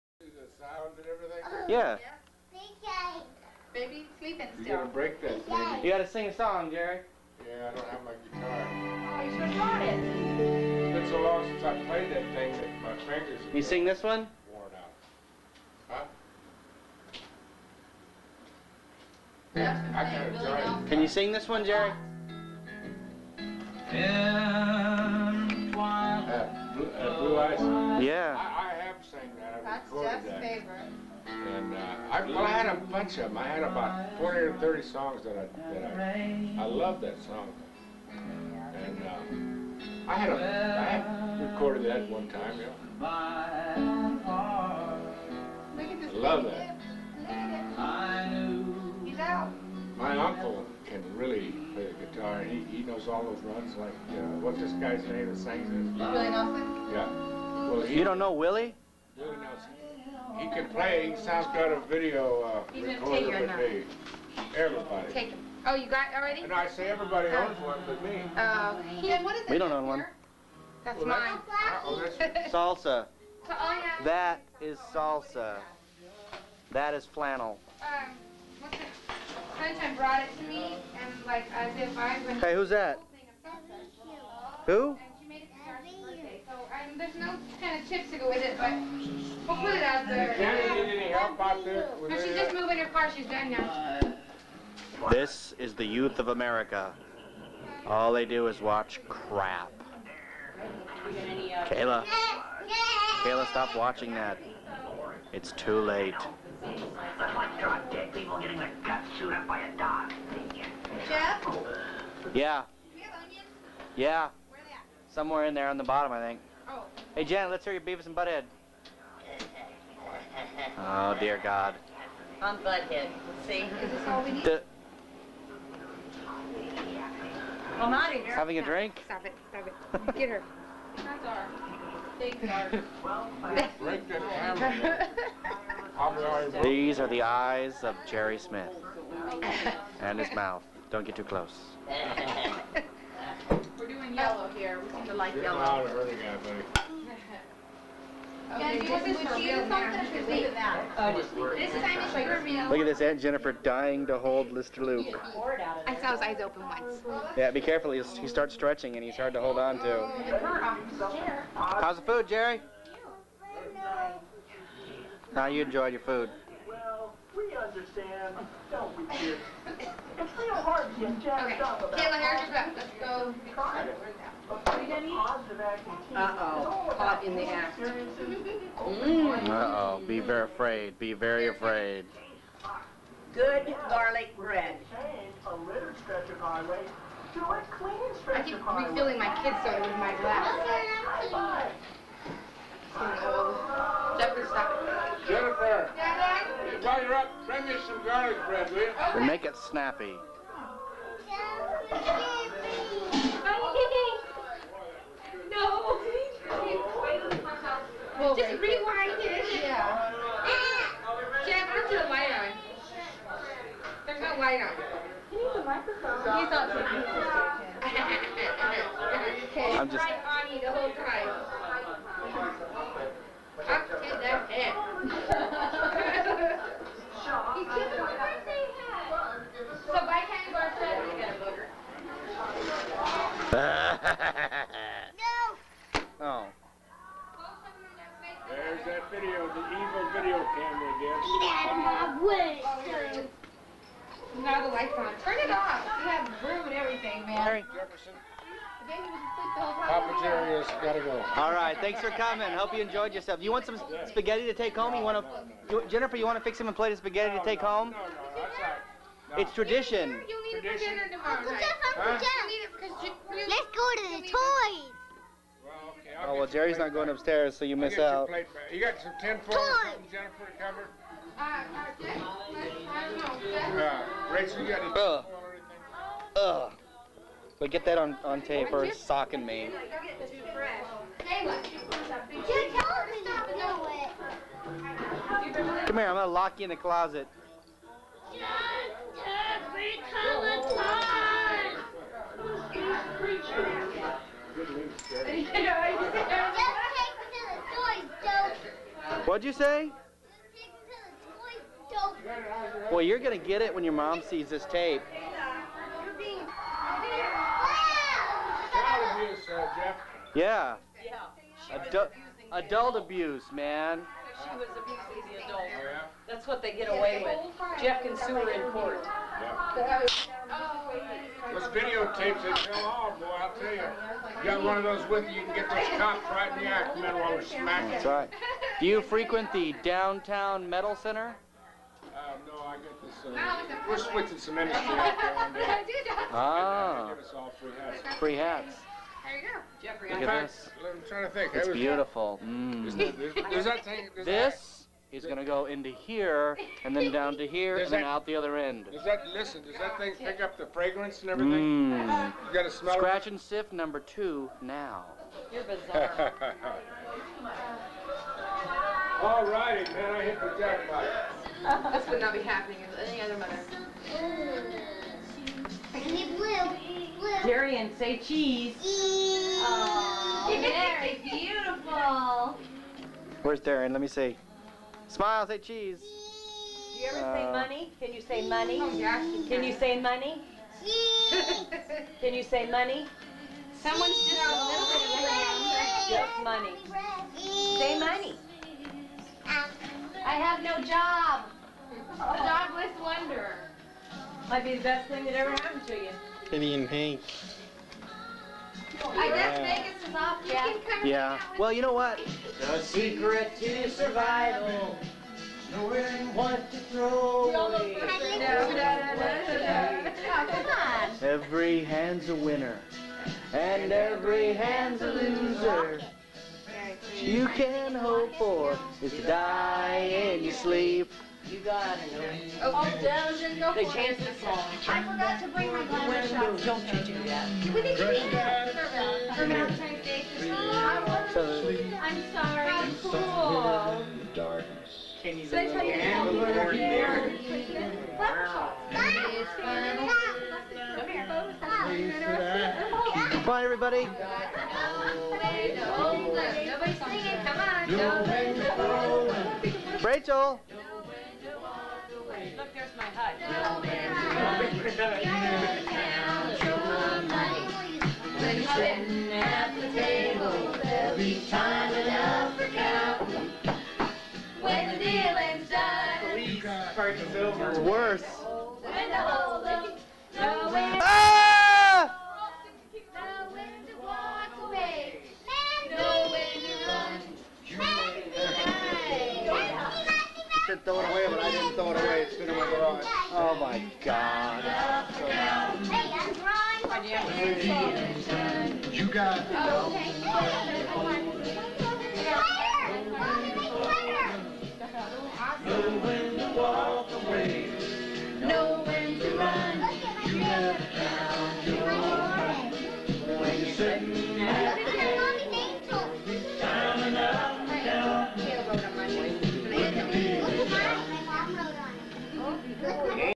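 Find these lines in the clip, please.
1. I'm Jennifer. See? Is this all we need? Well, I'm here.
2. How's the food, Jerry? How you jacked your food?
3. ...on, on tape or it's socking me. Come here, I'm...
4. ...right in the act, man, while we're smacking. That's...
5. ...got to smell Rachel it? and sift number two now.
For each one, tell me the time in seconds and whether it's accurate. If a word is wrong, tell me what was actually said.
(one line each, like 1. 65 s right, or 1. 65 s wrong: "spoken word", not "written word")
1. 122 s wrong: "Butthead", not "Jennifer"
2. 161 s wrong: "enjoyed", not "jacked"
3. 277 s right
4. 326 s right
5. 352 s wrong: "Scratch", not "Rachel".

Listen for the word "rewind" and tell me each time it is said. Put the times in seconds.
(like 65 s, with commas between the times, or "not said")
208 s.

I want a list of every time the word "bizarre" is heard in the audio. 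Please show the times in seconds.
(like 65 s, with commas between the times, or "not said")
355 s.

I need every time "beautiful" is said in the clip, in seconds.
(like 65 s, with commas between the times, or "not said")
341 s, 371 s.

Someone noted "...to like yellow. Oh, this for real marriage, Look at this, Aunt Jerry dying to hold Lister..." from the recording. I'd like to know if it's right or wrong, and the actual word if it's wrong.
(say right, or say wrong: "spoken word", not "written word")
wrong: "Jennifer", not "Jerry".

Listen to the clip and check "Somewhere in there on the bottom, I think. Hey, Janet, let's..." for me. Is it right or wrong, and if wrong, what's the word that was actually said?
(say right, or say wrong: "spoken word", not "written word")
right.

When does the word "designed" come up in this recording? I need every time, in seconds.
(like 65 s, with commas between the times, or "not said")
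not said.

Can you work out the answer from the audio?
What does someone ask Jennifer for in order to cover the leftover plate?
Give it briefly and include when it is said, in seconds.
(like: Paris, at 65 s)
tinfoil, at 269 s.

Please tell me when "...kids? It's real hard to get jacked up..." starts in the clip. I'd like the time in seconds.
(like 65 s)
169 s.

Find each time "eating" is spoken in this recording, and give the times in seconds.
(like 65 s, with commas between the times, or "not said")
175 s.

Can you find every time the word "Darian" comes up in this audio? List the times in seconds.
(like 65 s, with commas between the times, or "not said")
367 s, 373 s.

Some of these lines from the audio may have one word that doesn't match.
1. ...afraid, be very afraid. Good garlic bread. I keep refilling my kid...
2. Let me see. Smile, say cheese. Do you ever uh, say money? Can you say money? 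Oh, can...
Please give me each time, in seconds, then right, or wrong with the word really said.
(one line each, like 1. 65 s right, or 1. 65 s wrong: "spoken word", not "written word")
1. 180 s right
2. 373 s right.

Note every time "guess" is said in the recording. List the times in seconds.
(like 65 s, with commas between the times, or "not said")
272 s, 399 s.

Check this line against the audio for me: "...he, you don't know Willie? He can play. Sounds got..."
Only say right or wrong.
right.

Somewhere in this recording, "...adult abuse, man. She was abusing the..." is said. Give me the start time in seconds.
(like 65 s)
312 s.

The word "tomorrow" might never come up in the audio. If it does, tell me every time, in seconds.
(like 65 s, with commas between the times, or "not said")
261 s.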